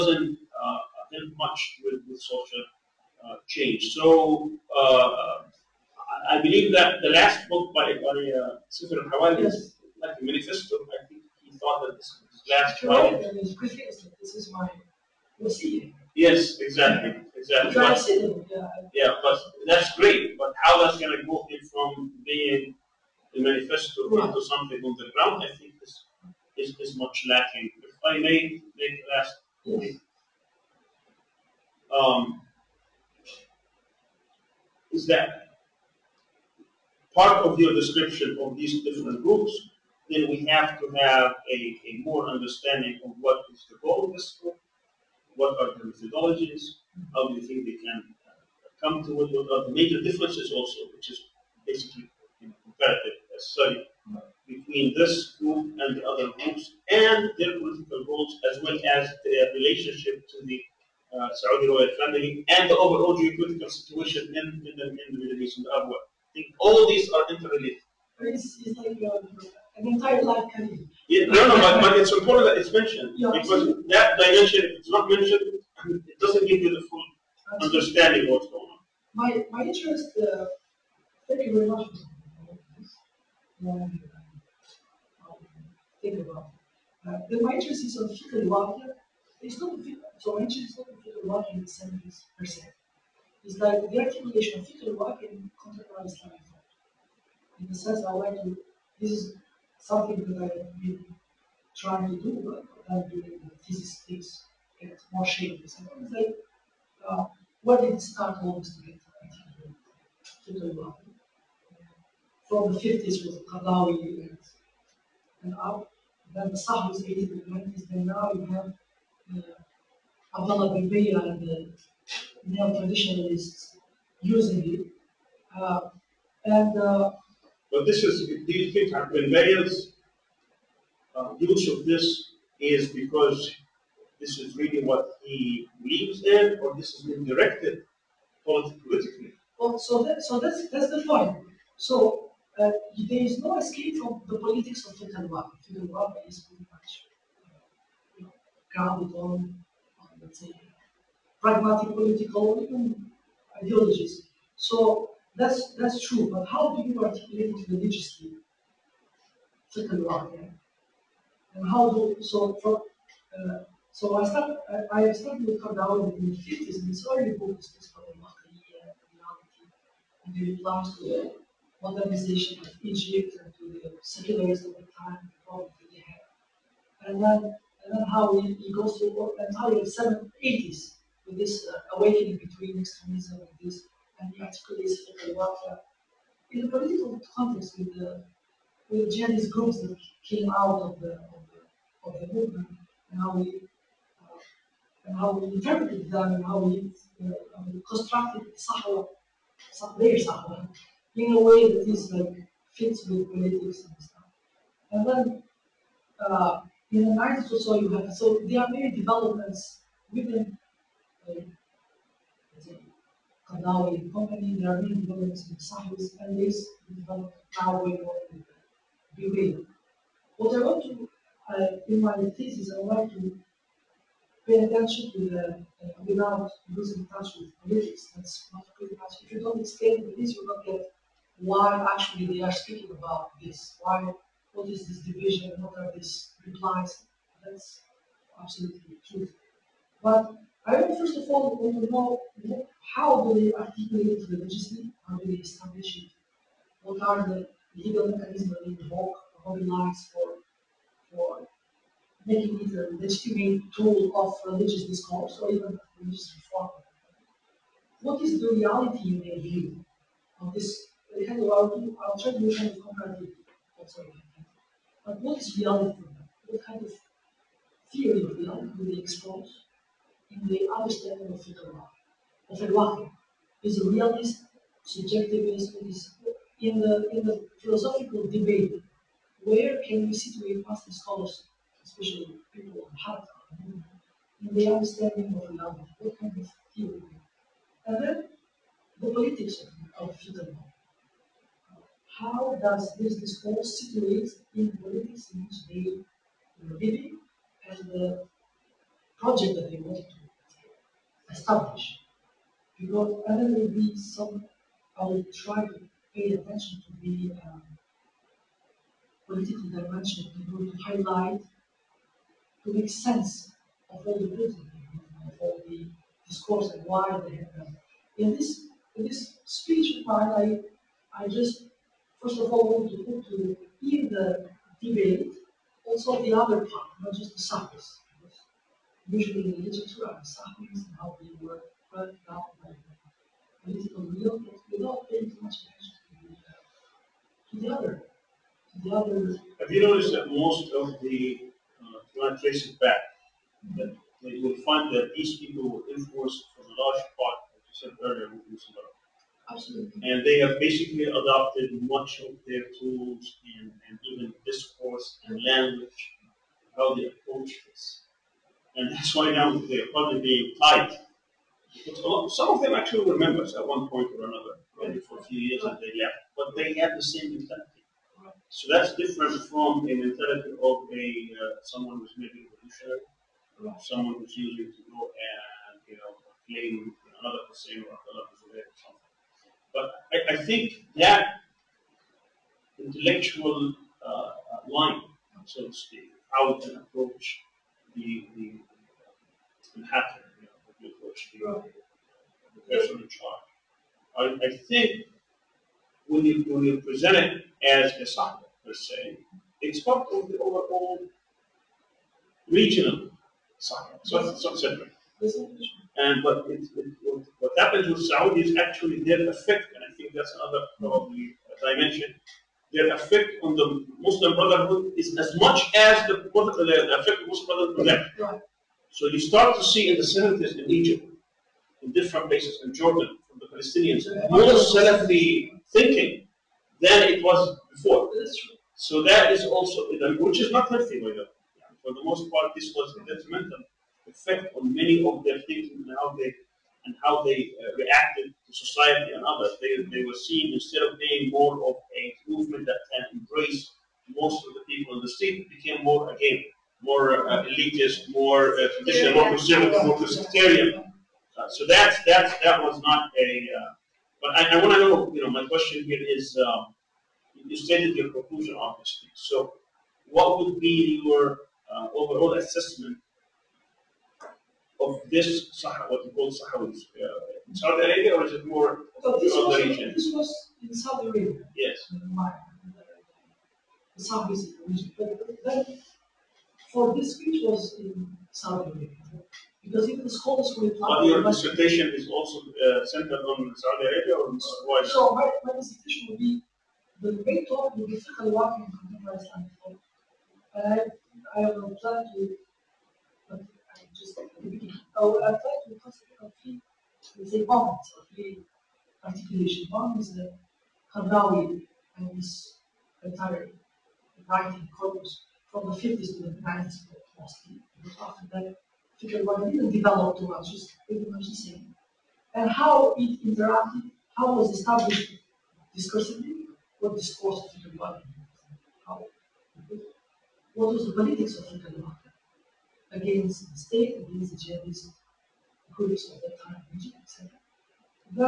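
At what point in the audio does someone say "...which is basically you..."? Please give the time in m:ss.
0:50.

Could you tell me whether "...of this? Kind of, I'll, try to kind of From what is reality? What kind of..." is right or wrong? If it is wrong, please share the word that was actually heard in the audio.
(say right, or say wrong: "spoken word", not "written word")
wrong: "But", not "From".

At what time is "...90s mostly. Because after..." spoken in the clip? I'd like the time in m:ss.
8:26.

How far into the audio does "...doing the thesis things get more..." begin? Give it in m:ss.
1:43.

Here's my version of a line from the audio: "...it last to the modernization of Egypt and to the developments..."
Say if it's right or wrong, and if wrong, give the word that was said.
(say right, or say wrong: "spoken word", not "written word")
wrong: "secularists", not "developments".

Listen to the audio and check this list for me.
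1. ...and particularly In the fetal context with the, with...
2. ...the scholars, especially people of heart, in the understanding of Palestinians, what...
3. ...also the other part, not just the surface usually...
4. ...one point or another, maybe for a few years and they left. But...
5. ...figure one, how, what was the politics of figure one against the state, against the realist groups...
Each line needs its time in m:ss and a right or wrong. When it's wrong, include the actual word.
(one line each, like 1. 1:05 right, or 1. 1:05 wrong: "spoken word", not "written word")
1. 3:04 wrong: "political", not "fetal"
2. 4:40 wrong: "Allah", not "Palestinians"
3. 5:25 right
4. 6:03 right
5. 8:37 wrong: "jihadist", not "realist".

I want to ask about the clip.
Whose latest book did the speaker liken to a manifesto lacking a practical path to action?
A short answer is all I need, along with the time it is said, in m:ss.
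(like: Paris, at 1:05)
Safar al-Hawali, at 0:08.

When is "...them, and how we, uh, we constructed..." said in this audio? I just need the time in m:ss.
3:16.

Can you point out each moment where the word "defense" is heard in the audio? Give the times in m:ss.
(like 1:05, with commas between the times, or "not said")
not said.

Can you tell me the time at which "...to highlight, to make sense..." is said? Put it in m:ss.
5:10.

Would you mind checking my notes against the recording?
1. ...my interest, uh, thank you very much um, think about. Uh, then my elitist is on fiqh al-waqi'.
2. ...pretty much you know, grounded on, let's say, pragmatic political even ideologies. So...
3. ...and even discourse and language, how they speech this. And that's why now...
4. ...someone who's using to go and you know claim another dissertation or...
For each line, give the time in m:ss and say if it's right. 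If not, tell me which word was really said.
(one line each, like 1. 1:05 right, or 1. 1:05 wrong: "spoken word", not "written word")
1. 1:19 wrong: "interest", not "elitist"
2. 2:26 right
3. 5:53 wrong: "approach", not "speech"
4. 6:13 wrong: "person", not "dissertation".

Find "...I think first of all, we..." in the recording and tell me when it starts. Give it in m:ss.
4:00.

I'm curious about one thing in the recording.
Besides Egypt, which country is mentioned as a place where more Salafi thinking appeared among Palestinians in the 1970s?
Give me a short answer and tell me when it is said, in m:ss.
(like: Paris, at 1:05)
Jordan, at 7:02.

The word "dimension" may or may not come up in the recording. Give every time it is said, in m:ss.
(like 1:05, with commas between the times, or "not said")
1:14, 5:09, 6:51.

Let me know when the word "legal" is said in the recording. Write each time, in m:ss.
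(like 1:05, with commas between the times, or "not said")
4:07.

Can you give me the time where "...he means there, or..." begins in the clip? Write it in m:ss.
2:15.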